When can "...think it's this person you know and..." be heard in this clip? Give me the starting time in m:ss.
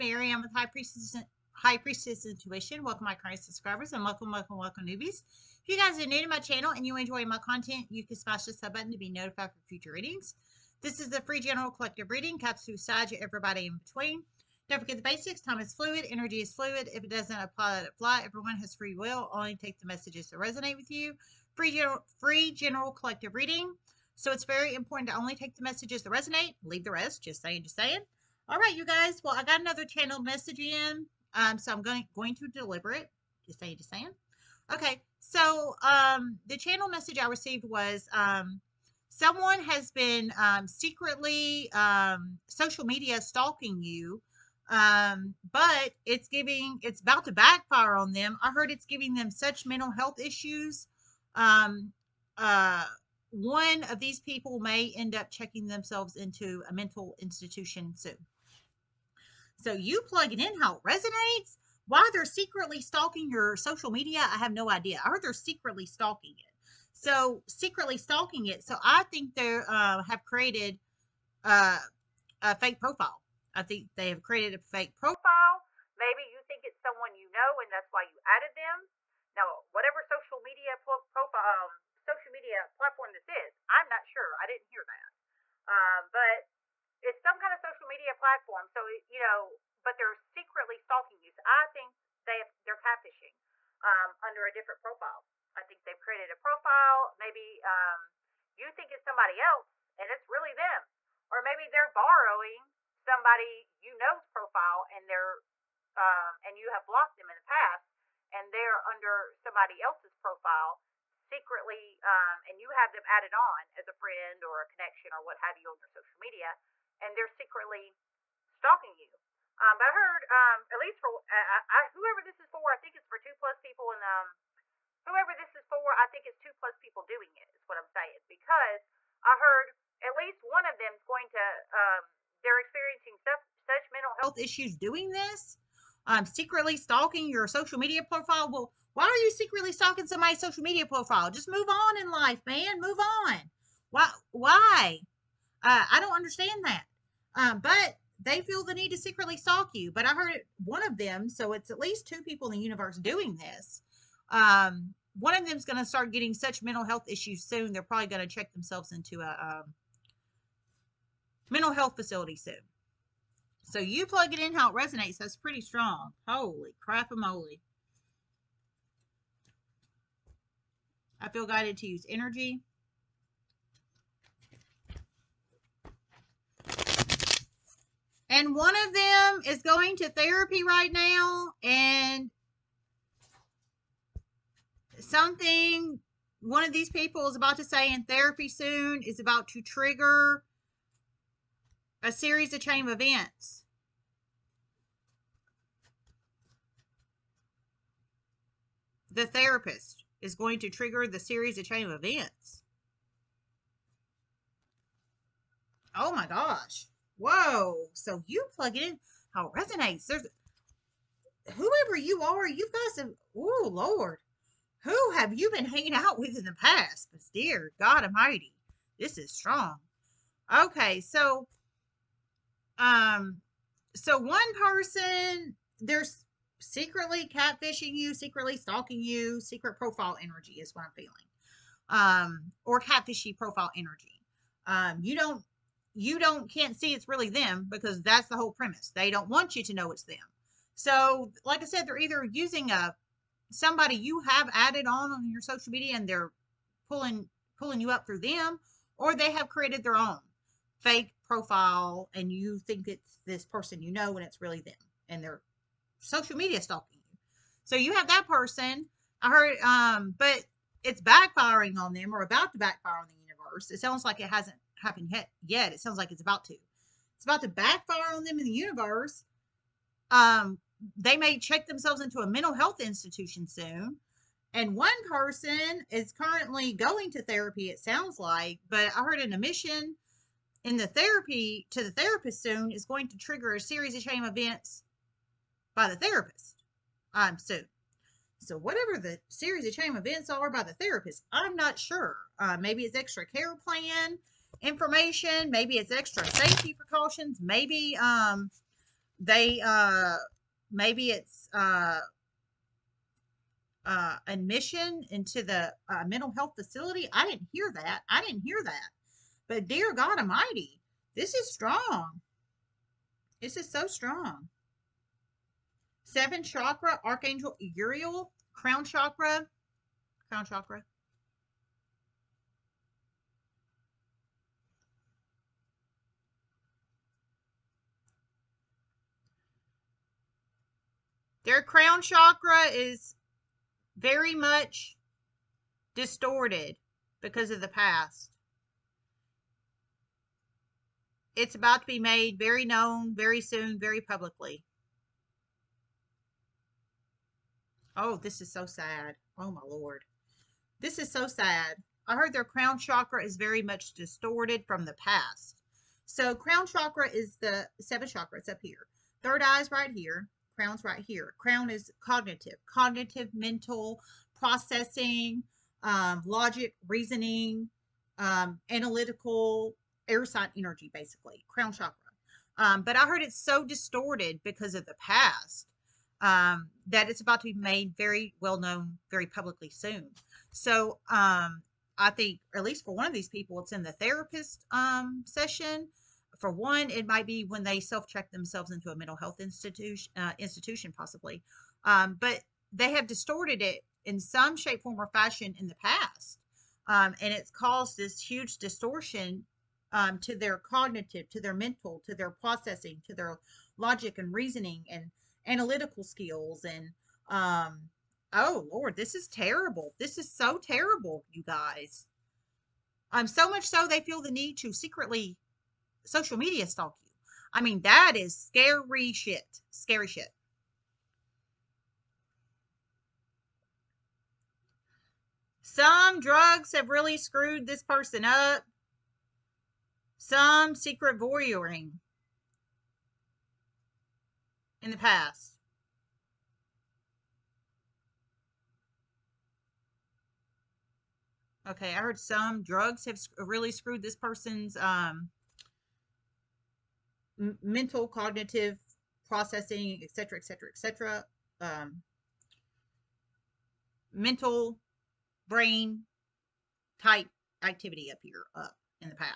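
4:12.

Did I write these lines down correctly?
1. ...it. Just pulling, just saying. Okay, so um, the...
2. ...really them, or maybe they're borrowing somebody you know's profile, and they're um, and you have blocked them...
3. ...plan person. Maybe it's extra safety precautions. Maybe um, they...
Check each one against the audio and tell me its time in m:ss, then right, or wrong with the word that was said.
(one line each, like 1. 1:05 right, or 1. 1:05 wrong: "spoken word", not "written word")
1. 0:32 wrong: "saying", not "pulling"
2. 1:40 right
3. 4:53 wrong: "information", not "person".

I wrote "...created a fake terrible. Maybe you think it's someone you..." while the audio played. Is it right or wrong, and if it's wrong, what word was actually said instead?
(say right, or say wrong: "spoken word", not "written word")
wrong: "profile", not "terrible".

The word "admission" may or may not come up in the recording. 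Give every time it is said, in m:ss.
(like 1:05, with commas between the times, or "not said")
4:39, 5:04.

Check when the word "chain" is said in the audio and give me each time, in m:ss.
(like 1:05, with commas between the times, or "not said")
3:12, 3:21.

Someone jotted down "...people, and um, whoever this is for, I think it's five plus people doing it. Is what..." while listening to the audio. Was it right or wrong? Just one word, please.
wrong.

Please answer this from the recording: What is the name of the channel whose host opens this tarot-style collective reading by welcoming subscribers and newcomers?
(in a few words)
High Priestess Intuition.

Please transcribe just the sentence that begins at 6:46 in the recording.
And um, oh, Lord, this is terrible.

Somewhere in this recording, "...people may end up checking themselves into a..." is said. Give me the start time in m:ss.
0:54.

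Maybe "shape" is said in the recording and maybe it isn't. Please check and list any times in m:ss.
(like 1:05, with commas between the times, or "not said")
6:34.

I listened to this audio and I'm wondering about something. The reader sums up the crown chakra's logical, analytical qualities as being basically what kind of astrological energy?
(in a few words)
air sign energy.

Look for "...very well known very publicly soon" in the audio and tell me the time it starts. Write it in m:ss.
6:17.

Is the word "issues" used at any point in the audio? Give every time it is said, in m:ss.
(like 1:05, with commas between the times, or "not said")
0:50, 2:14, 2:37.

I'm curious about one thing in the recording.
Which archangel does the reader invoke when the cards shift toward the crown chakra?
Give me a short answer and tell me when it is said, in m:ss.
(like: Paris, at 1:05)
Uriel, at 5:17.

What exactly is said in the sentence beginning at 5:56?
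So crown chakra is the seventh chakra.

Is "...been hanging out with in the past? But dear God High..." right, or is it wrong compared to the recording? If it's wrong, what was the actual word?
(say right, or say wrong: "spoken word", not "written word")
wrong: "Almighty", not "High".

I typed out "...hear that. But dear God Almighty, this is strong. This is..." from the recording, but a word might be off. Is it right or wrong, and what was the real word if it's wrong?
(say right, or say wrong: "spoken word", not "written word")
right.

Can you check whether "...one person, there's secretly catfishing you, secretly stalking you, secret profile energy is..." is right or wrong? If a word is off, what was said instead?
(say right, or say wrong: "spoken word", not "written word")
right.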